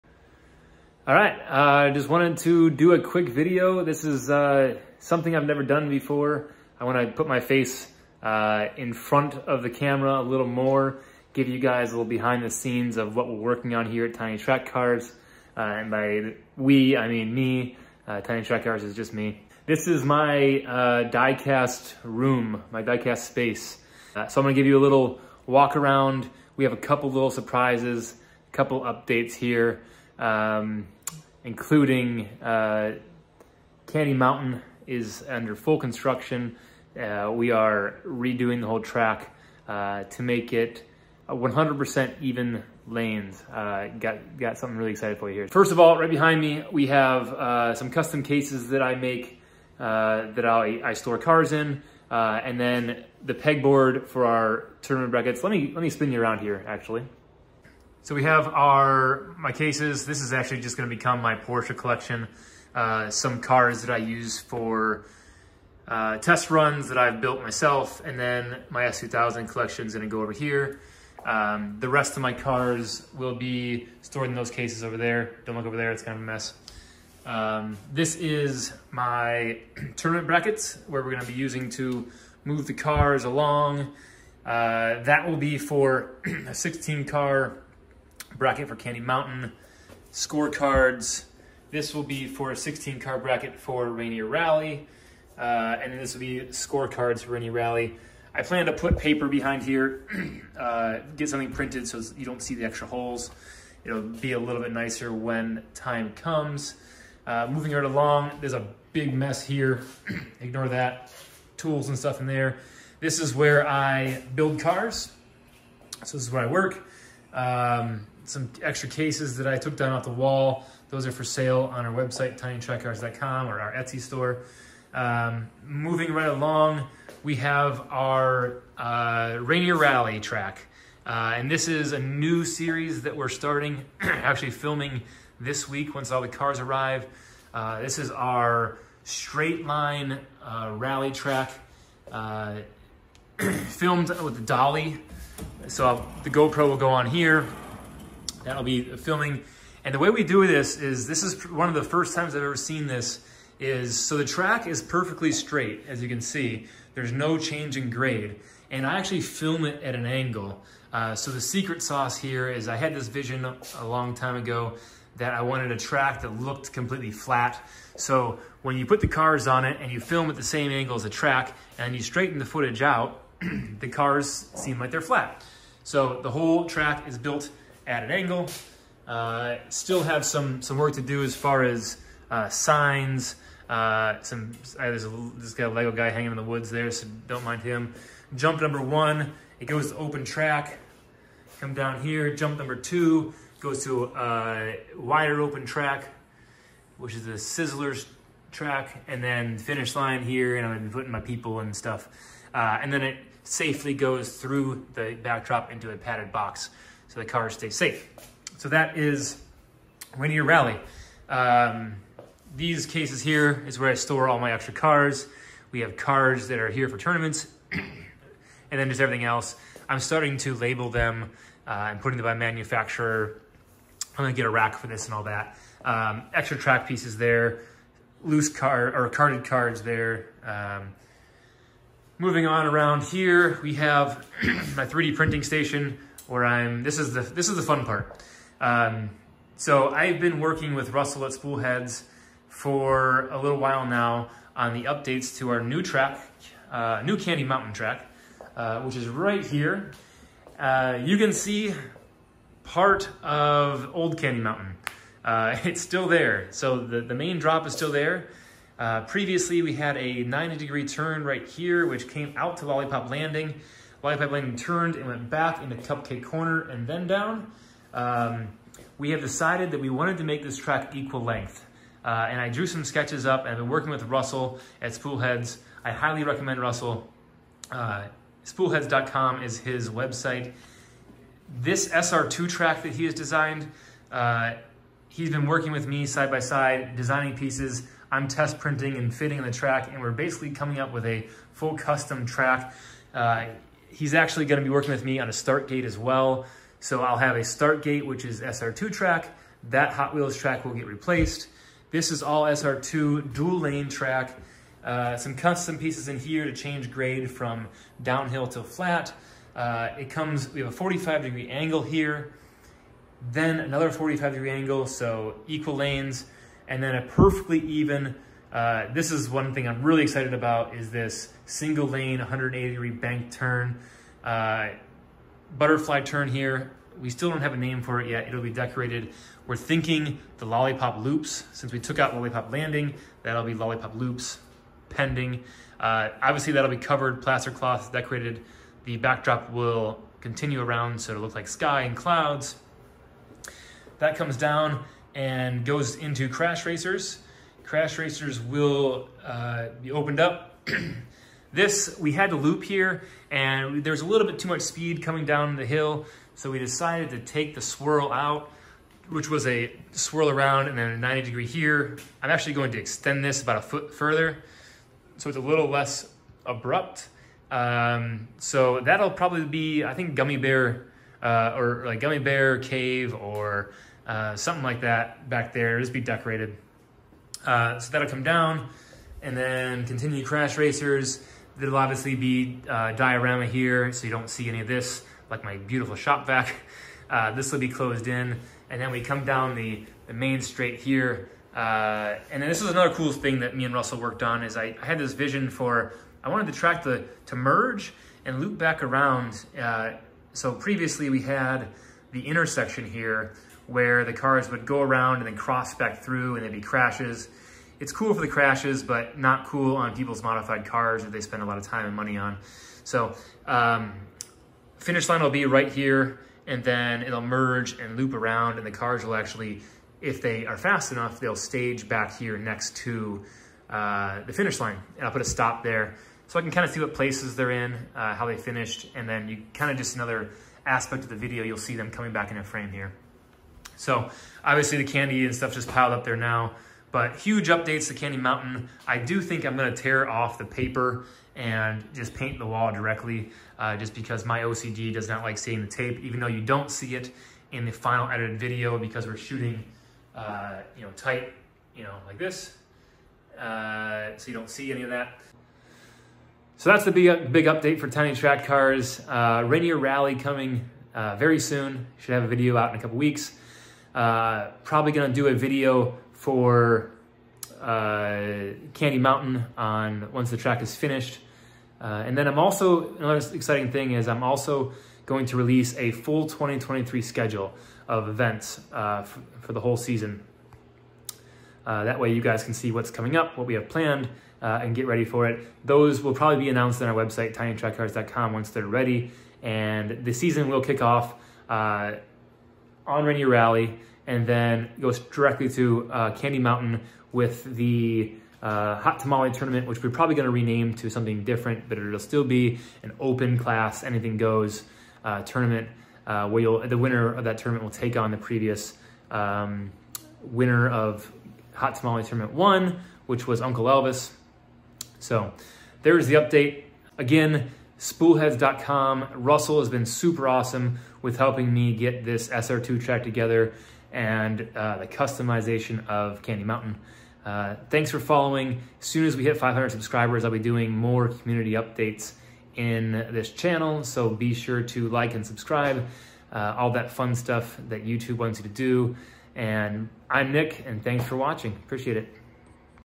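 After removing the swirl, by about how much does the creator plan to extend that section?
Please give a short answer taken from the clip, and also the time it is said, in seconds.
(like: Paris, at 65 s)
1 foot, at 363 s.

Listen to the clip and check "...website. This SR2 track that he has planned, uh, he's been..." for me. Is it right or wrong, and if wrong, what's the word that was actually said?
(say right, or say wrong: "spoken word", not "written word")
wrong: "designed", not "planned".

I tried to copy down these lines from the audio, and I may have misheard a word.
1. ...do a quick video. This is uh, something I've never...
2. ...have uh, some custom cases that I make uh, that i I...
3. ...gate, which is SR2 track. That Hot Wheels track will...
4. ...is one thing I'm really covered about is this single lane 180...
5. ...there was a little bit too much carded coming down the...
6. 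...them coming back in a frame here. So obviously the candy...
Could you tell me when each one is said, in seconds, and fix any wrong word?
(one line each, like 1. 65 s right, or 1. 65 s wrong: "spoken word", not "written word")
1. 2 s right
2. 46 s right
3. 297 s right
4. 319 s wrong: "excited", not "covered"
5. 353 s wrong: "speed", not "carded"
6. 431 s right.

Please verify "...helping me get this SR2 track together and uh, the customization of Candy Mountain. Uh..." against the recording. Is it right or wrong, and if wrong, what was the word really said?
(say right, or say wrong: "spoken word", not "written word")
right.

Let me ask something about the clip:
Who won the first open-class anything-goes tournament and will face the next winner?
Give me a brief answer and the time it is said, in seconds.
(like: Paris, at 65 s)
Uncle Elvis, at 513 s.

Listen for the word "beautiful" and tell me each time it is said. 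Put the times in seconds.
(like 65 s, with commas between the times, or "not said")
385 s.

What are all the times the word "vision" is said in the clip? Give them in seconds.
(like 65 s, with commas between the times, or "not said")
163 s, 395 s.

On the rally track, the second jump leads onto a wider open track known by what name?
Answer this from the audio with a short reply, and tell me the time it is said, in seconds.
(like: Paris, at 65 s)
Sizzlers track, at 197 s.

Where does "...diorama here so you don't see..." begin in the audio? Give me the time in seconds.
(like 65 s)
382 s.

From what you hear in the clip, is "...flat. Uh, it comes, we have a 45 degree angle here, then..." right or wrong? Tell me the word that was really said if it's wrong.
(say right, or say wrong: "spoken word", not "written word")
right.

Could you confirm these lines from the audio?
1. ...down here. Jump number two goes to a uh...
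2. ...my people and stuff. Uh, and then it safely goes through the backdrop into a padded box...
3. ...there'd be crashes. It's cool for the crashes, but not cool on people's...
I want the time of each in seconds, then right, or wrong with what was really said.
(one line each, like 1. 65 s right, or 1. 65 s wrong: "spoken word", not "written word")
1. 191 s right
2. 201 s right
3. 406 s right.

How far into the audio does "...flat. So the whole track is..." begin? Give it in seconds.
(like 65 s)
175 s.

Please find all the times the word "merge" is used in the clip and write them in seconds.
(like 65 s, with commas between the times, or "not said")
397 s, 417 s.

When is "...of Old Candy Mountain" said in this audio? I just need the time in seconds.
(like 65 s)
253 s.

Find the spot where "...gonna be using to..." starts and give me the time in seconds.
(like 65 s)
81 s.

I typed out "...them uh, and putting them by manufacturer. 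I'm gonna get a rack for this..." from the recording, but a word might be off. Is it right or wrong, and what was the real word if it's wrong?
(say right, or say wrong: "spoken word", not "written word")
right.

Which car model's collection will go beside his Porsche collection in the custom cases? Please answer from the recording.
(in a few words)
S2000.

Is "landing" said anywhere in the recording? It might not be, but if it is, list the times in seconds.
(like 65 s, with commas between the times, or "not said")
263 s, 332 s.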